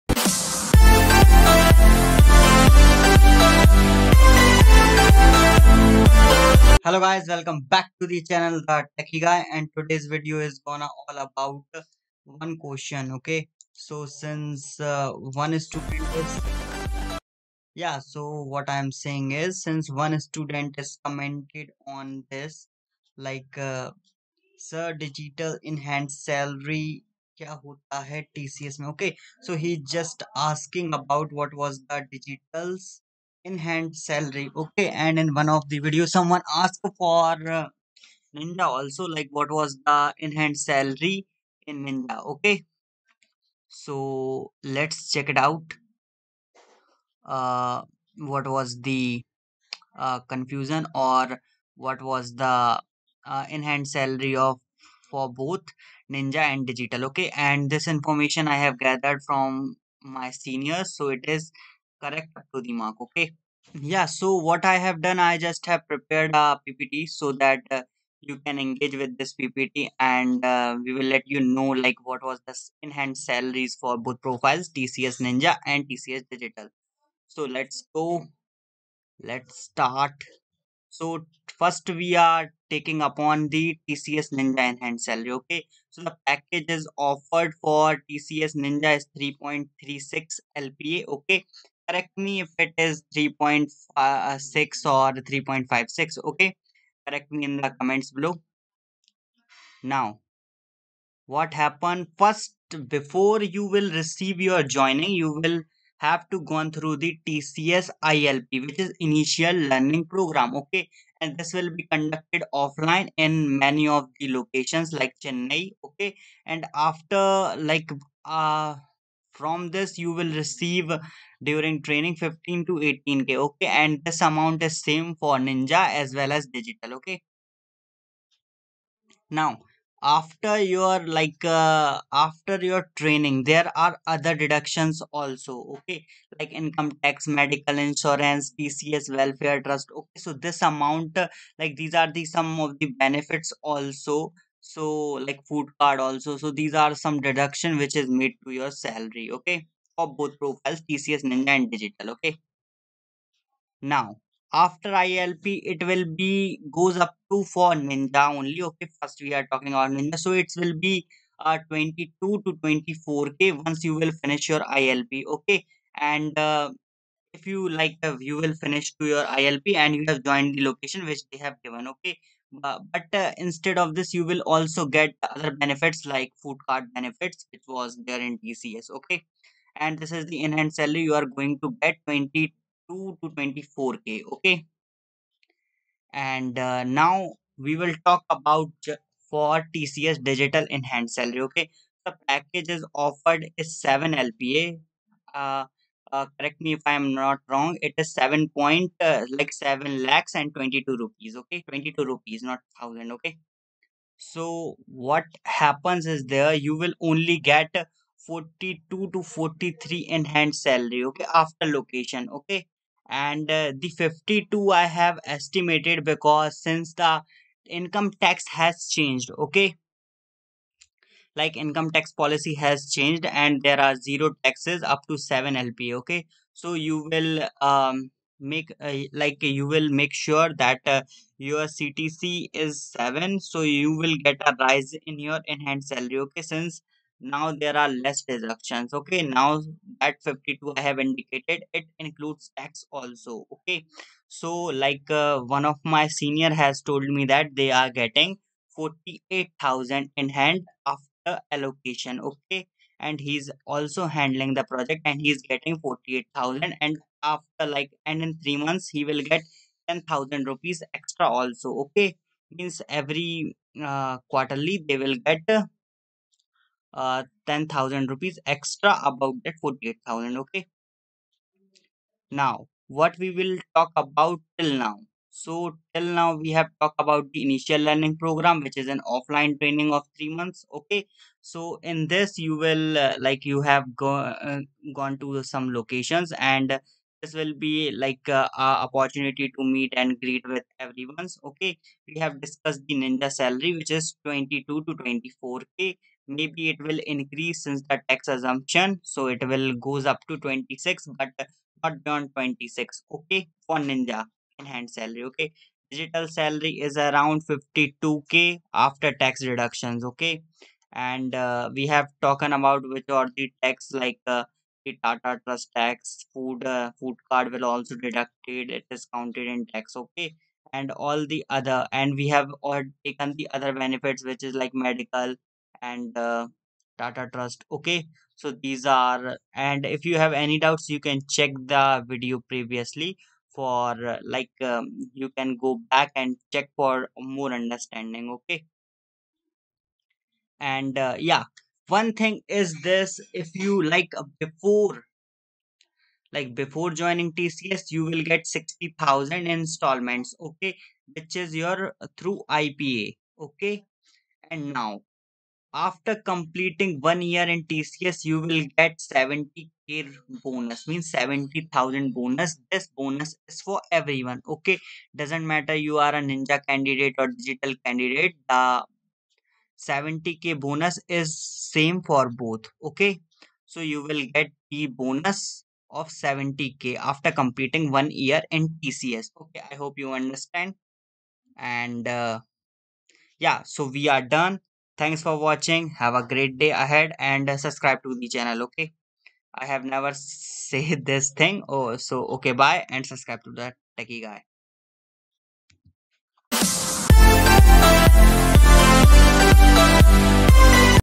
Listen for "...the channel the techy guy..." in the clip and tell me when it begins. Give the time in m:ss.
0:08.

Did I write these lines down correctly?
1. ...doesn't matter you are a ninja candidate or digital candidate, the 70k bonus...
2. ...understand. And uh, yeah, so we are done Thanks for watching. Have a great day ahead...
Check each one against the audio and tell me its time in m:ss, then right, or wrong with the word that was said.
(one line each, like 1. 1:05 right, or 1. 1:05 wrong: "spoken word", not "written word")
1. 6:05 right
2. 6:20 right.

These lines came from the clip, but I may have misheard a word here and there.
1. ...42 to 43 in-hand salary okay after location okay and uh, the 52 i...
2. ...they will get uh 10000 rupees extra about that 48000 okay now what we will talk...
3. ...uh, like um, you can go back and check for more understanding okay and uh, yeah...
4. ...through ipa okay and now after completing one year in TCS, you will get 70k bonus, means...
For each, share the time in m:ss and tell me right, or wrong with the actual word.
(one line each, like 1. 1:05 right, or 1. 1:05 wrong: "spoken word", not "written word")
1. 3:28 right
2. 4:24 right
3. 5:34 right
4. 5:52 right.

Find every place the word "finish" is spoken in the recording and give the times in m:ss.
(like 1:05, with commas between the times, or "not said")
2:44, 2:48.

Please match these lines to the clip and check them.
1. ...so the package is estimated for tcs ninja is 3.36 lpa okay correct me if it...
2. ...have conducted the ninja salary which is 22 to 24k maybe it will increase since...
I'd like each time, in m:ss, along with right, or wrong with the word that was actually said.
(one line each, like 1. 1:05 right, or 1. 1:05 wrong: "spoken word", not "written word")
1. 1:25 wrong: "offered", not "estimated"
2. 4:52 wrong: "discussed", not "conducted".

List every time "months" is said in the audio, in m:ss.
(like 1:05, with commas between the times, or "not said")
4:18, 4:40.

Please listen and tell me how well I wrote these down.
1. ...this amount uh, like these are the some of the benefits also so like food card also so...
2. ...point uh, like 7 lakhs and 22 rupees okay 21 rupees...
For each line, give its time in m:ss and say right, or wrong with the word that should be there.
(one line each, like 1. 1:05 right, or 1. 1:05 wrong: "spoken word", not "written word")
1. 2:20 right
2. 3:18 wrong: "22", not "21".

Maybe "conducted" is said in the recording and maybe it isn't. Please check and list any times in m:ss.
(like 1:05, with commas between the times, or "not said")
1:51.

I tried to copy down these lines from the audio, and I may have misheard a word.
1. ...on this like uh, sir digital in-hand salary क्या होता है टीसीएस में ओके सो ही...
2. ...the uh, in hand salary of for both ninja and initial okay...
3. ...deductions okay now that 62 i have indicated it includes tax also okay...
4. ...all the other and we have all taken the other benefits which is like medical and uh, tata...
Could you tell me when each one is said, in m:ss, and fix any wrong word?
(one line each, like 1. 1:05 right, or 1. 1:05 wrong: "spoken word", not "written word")
1. 0:21 right
2. 0:52 wrong: "digital", not "initial"
3. 3:58 wrong: "52", not "62"
4. 5:20 right.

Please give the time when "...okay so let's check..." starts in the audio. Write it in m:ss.
0:42.